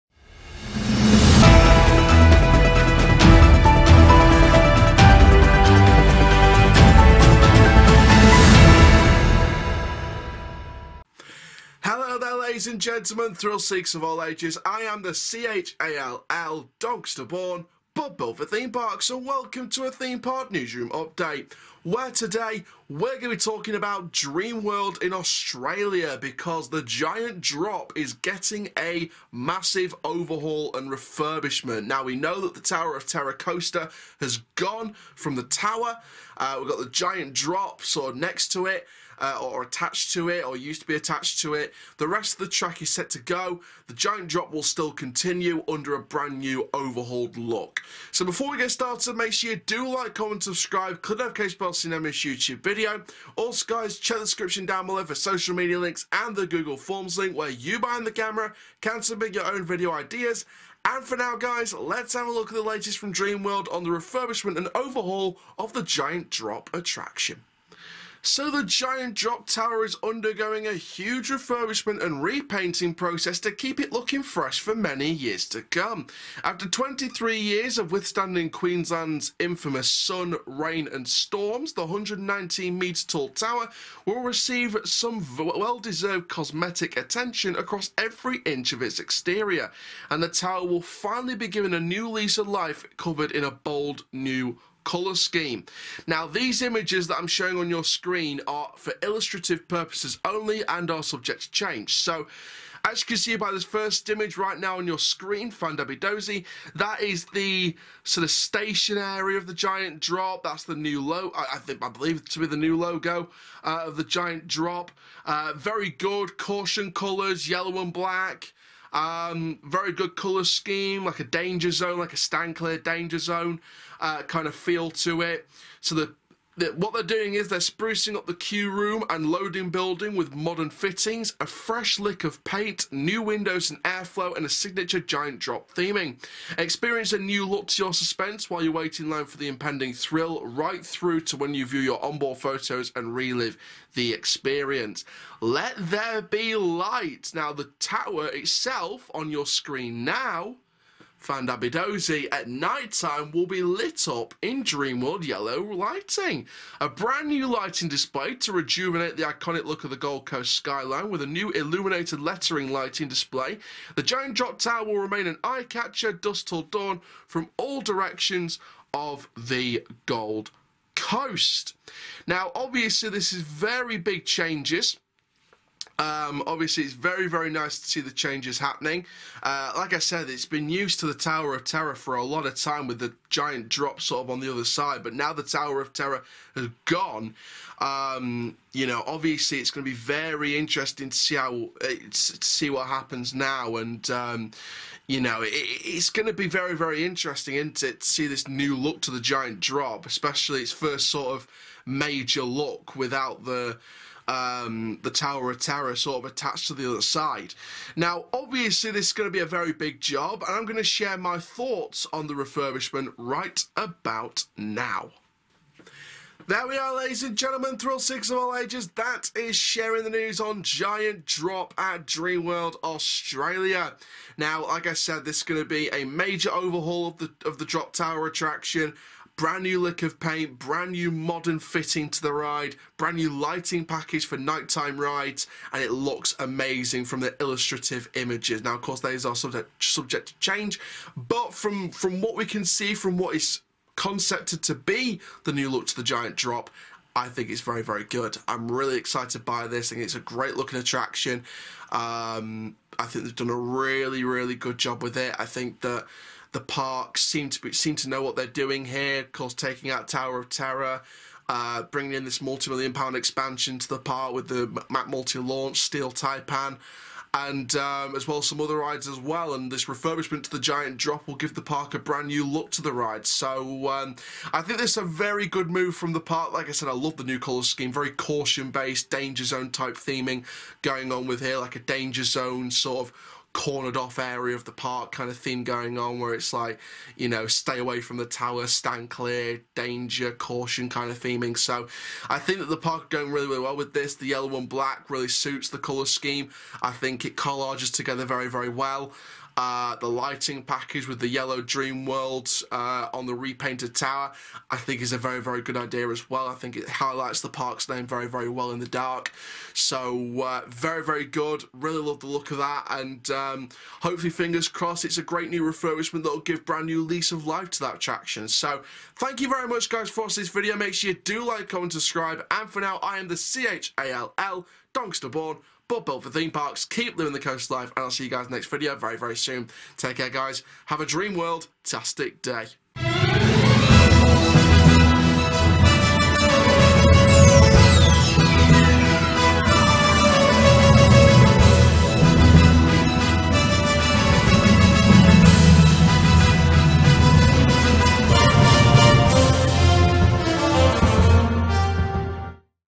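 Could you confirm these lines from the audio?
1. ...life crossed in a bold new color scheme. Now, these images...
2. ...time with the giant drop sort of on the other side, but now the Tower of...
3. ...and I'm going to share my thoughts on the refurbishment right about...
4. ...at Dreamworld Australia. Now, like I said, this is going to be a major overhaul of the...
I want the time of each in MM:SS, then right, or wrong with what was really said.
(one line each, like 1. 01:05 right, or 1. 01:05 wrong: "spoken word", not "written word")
1. 01:32 wrong: "covered", not "crossed"
2. 03:02 right
3. 03:30 right
4. 03:41 right.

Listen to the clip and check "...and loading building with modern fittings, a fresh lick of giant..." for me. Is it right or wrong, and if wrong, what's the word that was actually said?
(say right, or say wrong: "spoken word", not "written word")
wrong: "paint", not "giant".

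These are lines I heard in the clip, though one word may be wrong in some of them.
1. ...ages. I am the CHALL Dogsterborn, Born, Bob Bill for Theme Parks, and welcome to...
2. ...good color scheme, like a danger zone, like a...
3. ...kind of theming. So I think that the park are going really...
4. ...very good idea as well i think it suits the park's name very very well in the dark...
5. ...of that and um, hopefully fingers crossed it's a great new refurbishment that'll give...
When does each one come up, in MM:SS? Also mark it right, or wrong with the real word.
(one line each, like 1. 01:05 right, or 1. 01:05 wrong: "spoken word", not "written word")
1. 00:14 right
2. 01:59 right
3. 04:50 right
4. 05:05 wrong: "highlights", not "suits"
5. 05:12 right.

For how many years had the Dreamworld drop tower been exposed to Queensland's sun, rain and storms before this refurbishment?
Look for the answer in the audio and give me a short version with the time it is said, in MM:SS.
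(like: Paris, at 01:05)
23, at 01:16.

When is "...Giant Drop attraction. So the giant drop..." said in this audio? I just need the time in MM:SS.
01:05.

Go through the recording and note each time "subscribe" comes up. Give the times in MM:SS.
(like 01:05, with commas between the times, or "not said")
00:50, 05:21.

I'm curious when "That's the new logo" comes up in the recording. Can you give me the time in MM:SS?
01:50.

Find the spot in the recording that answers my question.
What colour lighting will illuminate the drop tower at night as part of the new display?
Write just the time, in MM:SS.
02:34.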